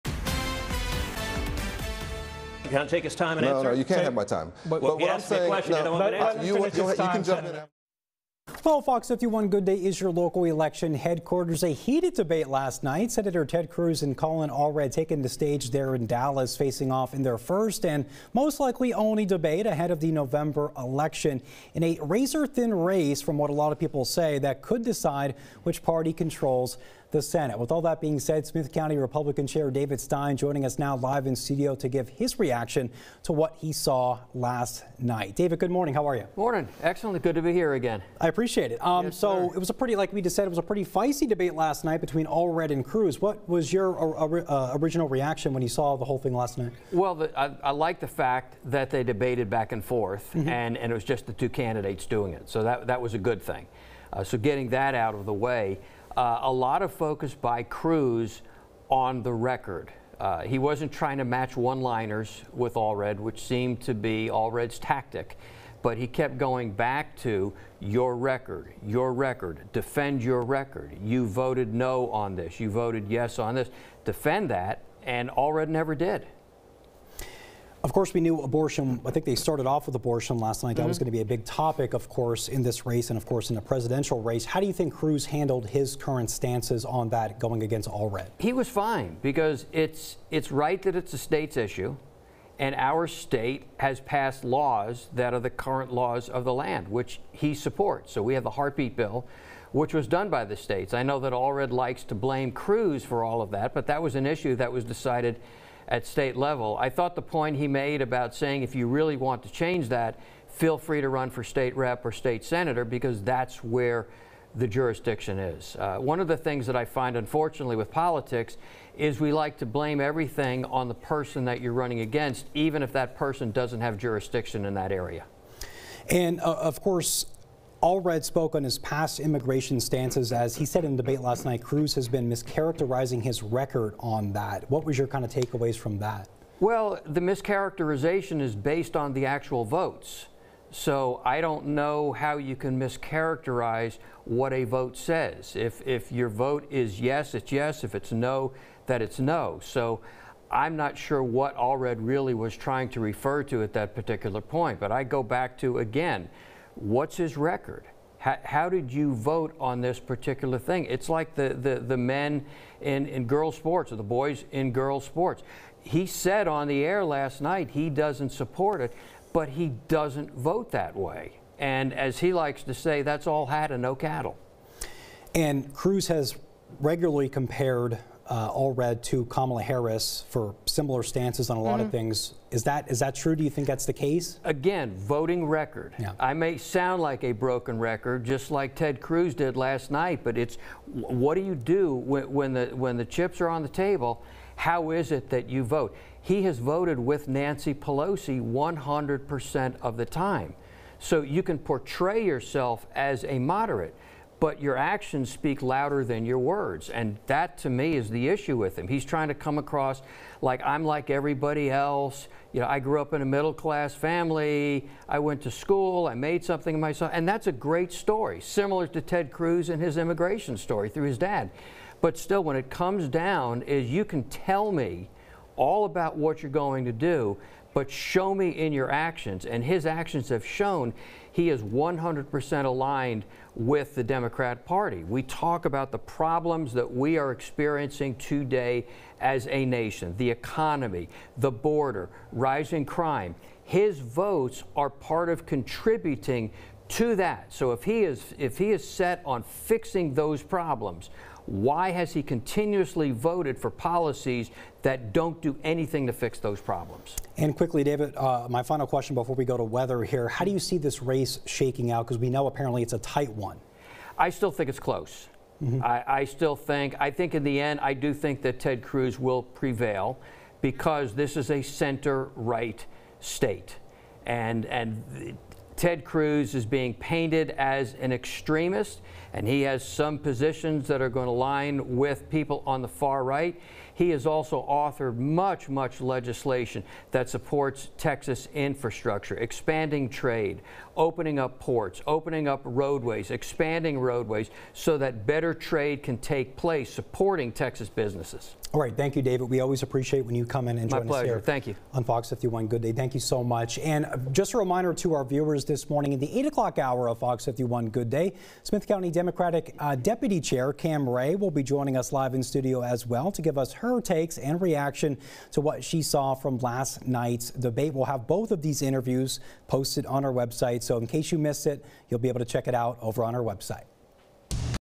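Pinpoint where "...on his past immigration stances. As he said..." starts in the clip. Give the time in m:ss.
2:08.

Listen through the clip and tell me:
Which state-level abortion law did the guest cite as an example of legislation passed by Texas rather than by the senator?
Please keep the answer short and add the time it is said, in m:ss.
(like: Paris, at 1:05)
heartbeat bill, at 1:38.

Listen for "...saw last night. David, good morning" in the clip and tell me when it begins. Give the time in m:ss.
0:33.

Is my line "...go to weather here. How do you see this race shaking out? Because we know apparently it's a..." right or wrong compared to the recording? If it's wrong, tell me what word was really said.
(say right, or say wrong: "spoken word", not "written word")
right.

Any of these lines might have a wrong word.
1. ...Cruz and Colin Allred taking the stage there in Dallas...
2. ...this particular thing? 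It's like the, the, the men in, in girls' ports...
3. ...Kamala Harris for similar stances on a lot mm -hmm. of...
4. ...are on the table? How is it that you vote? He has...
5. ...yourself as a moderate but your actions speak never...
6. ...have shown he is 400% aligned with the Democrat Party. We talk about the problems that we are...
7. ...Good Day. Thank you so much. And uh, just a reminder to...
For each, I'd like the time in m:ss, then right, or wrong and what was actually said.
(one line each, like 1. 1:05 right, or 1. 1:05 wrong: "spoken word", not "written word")
1. 0:13 right
2. 2:39 wrong: "sports", not "ports"
3. 2:59 right
4. 3:13 right
5. 3:22 wrong: "louder", not "never"
6. 3:50 wrong: "100", not "400"
7. 5:02 right.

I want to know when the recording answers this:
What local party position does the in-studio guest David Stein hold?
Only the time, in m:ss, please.
0:28.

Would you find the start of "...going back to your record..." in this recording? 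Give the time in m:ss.
1:06.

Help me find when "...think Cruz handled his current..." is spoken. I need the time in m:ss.
1:24.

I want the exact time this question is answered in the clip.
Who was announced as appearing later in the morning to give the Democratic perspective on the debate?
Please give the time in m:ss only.
5:10.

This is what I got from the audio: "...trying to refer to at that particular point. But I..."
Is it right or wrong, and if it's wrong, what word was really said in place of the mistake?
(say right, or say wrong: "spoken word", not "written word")
right.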